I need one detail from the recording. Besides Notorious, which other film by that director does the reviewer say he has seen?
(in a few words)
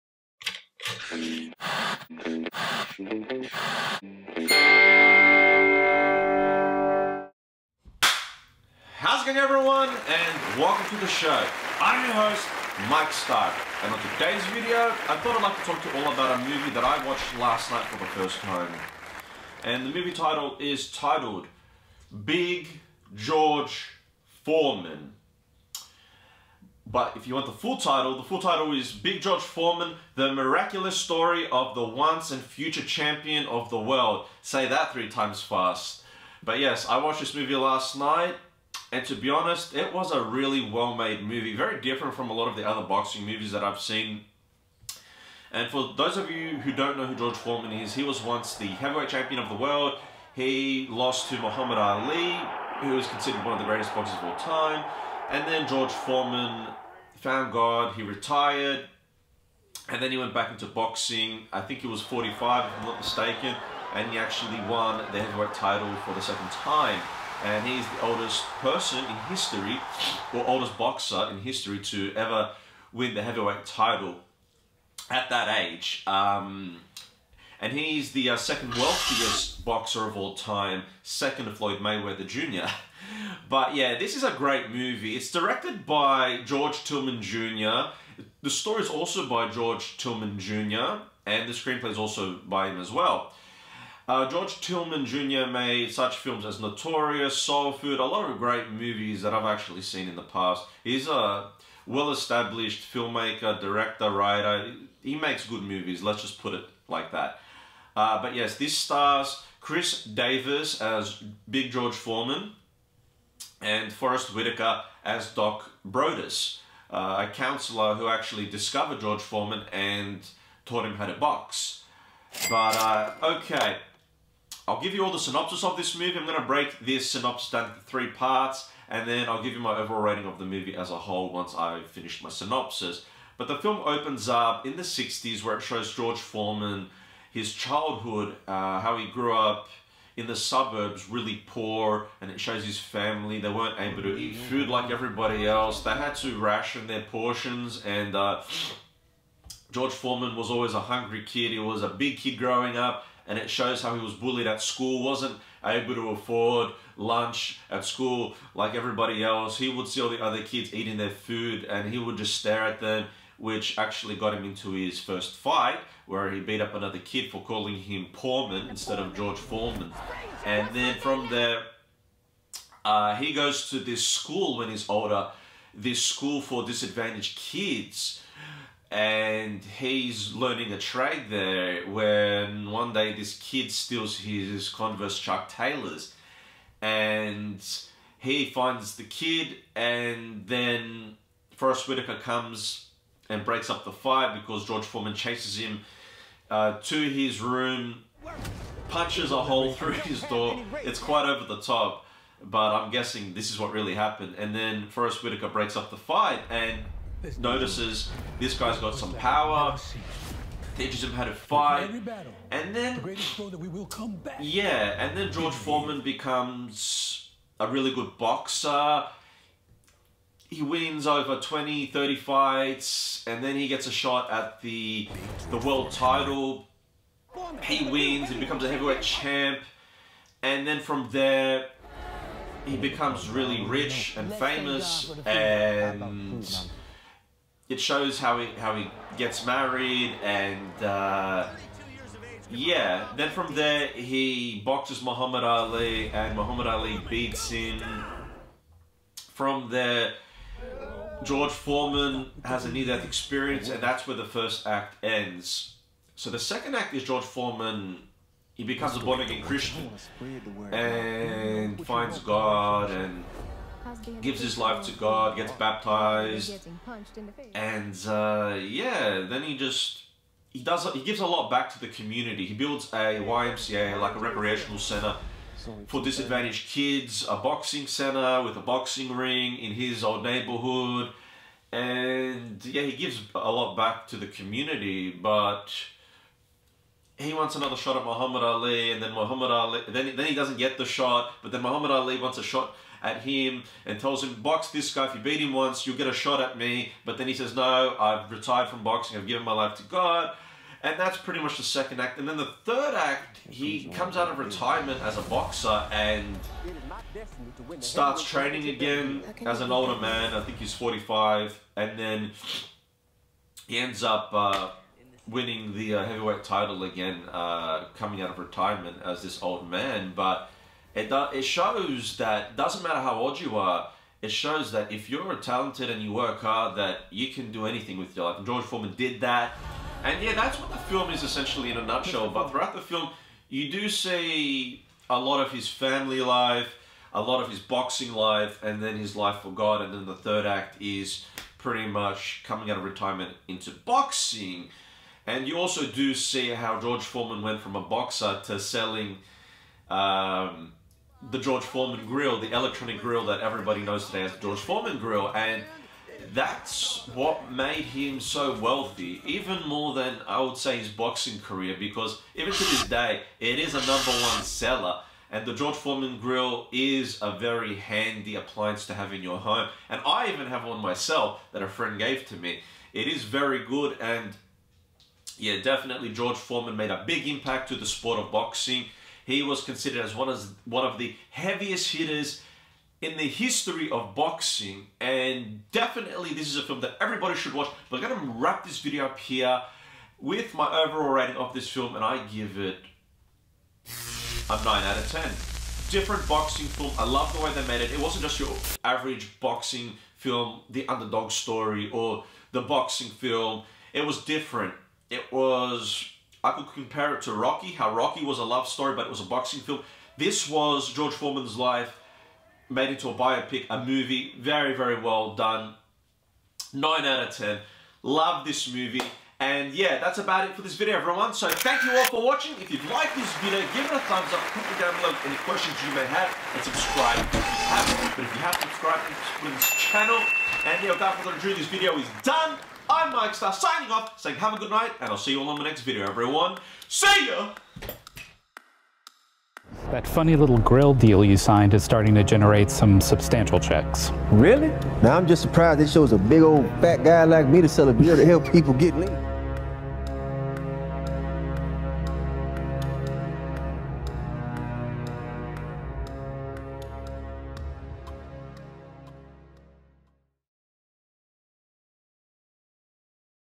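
Soul Food.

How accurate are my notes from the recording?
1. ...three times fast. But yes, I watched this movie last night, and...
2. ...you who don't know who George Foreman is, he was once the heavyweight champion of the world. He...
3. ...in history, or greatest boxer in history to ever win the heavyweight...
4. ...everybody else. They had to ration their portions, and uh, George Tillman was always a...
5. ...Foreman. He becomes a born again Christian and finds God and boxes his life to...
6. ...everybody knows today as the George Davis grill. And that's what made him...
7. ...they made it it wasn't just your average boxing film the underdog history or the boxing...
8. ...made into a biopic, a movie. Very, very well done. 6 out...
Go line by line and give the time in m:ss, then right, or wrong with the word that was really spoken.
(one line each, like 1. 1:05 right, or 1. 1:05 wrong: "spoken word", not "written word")
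1. 0:34 right
2. 0:46 right
3. 1:08 wrong: "oldest", not "greatest"
4. 2:24 wrong: "Foreman", not "Tillman"
5. 4:17 wrong: "gives", not "boxes"
6. 5:53 wrong: "Foreman", not "Davis"
7. 6:37 wrong: "story", not "history"
8. 6:52 wrong: "9", not "6".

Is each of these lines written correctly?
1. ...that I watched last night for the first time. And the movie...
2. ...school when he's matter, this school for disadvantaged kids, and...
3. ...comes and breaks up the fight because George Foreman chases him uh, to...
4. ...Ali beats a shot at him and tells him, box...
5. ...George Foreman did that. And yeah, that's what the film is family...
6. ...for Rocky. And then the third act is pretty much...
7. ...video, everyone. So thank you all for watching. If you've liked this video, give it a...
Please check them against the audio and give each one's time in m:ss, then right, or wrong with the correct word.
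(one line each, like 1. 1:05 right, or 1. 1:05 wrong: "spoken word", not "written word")
1. 0:16 right
2. 2:54 wrong: "older", not "matter"
3. 3:12 right
4. 4:51 wrong: "wants", not "beats"
5. 5:28 wrong: "essentially", not "family"
6. 5:39 wrong: "God", not "Rocky"
7. 7:00 right.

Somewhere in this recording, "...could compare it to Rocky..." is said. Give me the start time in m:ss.
6:46.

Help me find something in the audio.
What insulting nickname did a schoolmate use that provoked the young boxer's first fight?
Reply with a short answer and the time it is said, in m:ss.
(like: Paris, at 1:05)
Poorman, at 2:48.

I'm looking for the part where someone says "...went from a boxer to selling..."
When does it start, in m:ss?
5:47.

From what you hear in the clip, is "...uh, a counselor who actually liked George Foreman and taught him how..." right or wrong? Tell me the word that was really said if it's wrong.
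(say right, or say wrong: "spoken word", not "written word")
wrong: "discovered", not "liked".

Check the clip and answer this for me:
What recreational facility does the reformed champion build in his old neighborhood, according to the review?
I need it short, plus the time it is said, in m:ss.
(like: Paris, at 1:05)
YMCA, at 4:33.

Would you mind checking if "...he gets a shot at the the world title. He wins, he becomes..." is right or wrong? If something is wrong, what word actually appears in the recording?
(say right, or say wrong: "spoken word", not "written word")
right.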